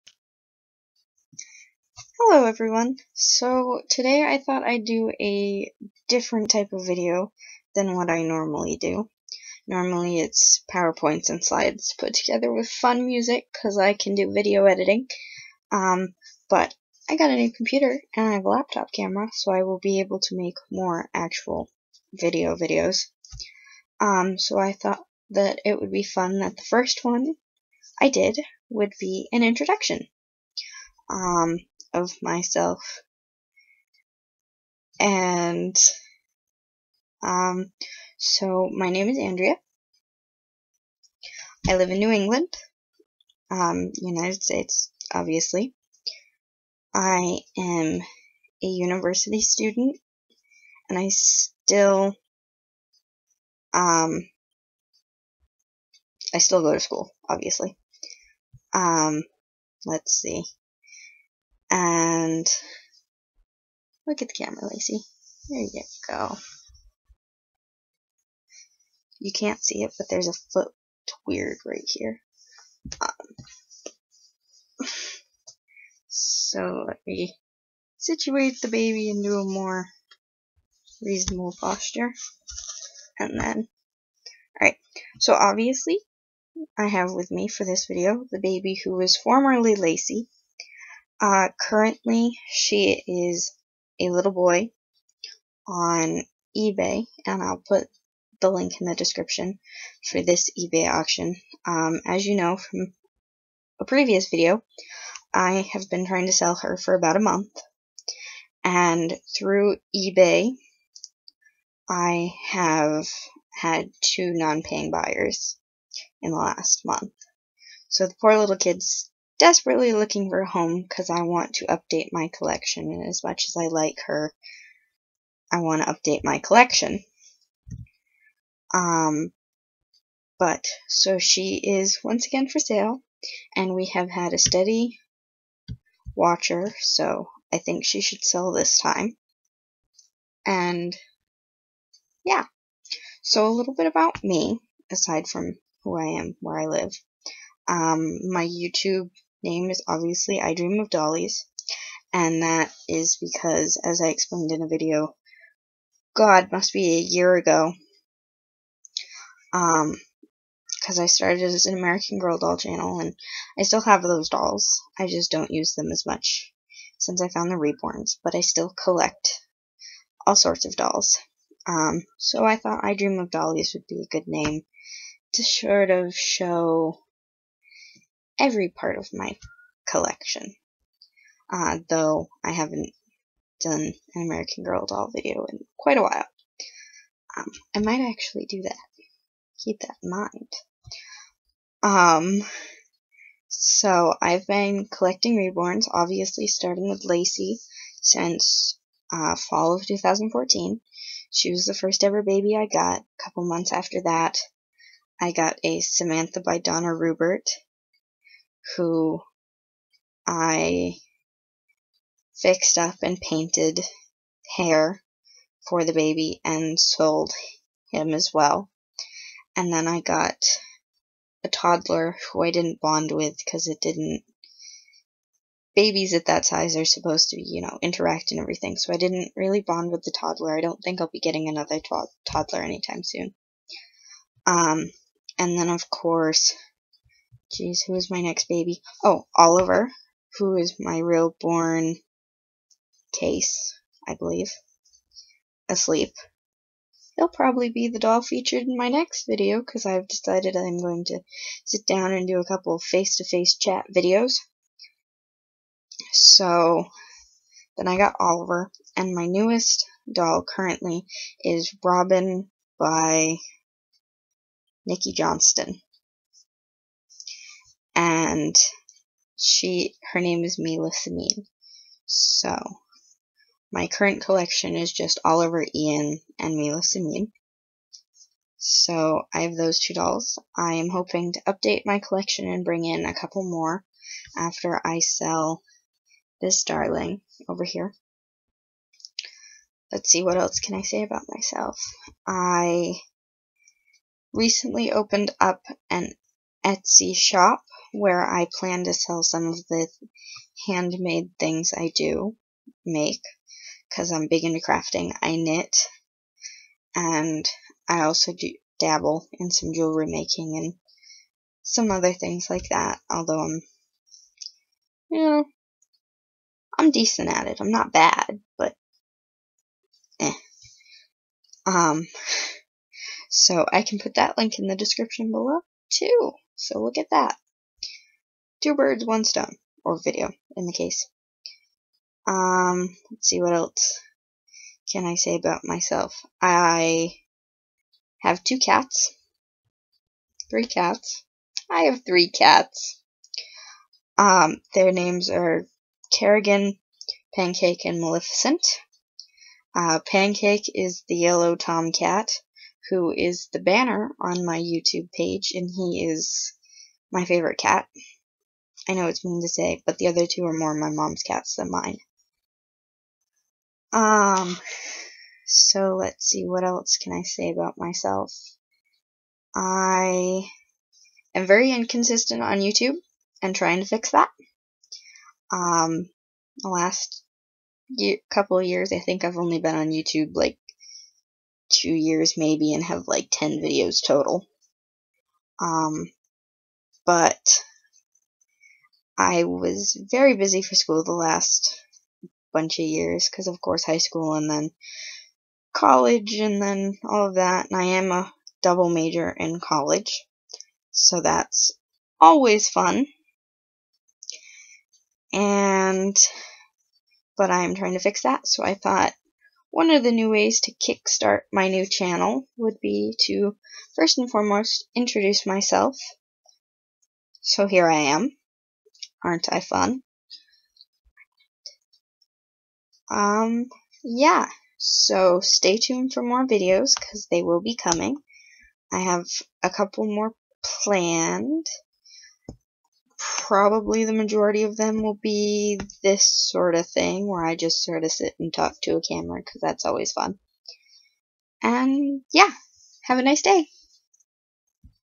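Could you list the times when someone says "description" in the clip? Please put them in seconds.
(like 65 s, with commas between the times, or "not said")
98 s, 324 s.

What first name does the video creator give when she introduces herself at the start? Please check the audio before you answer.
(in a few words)
Andrea.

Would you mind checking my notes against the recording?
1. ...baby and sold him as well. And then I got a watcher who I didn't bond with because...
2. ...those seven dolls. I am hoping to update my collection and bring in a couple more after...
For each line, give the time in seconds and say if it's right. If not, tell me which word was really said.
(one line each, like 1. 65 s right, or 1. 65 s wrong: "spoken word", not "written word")
1. 215 s wrong: "toddler", not "watcher"
2. 279 s wrong: "two", not "seven".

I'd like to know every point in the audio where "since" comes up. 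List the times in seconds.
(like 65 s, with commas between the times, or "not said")
166 s, 198 s.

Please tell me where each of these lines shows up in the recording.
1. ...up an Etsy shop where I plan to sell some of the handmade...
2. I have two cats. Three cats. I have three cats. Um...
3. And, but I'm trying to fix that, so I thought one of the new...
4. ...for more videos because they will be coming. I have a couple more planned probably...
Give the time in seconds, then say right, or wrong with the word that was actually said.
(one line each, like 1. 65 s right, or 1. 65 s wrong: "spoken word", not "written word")
1. 295 s right
2. 336 s right
3. 405 s right
4. 426 s right.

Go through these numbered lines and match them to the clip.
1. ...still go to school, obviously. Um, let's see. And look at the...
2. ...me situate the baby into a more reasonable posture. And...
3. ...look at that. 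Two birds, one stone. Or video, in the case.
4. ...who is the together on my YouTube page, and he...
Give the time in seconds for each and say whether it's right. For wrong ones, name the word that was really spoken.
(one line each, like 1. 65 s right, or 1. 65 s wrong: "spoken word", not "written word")
1. 56 s right
2. 77 s right
3. 326 s right
4. 352 s wrong: "banner", not "together".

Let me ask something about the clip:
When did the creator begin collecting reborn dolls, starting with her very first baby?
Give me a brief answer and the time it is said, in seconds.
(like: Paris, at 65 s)
fall of 2014, at 199 s.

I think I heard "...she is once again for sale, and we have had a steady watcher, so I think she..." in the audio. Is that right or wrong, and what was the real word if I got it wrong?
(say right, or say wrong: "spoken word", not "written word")
right.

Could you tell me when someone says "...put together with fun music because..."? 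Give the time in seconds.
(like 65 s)
11 s.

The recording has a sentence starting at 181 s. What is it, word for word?
Uh, though I haven't done an American Girl doll video in quite a while.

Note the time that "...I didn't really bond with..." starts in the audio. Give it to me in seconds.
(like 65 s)
228 s.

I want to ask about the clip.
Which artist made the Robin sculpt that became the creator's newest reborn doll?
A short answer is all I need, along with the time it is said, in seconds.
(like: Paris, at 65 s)
Nikki Johnston, at 264 s.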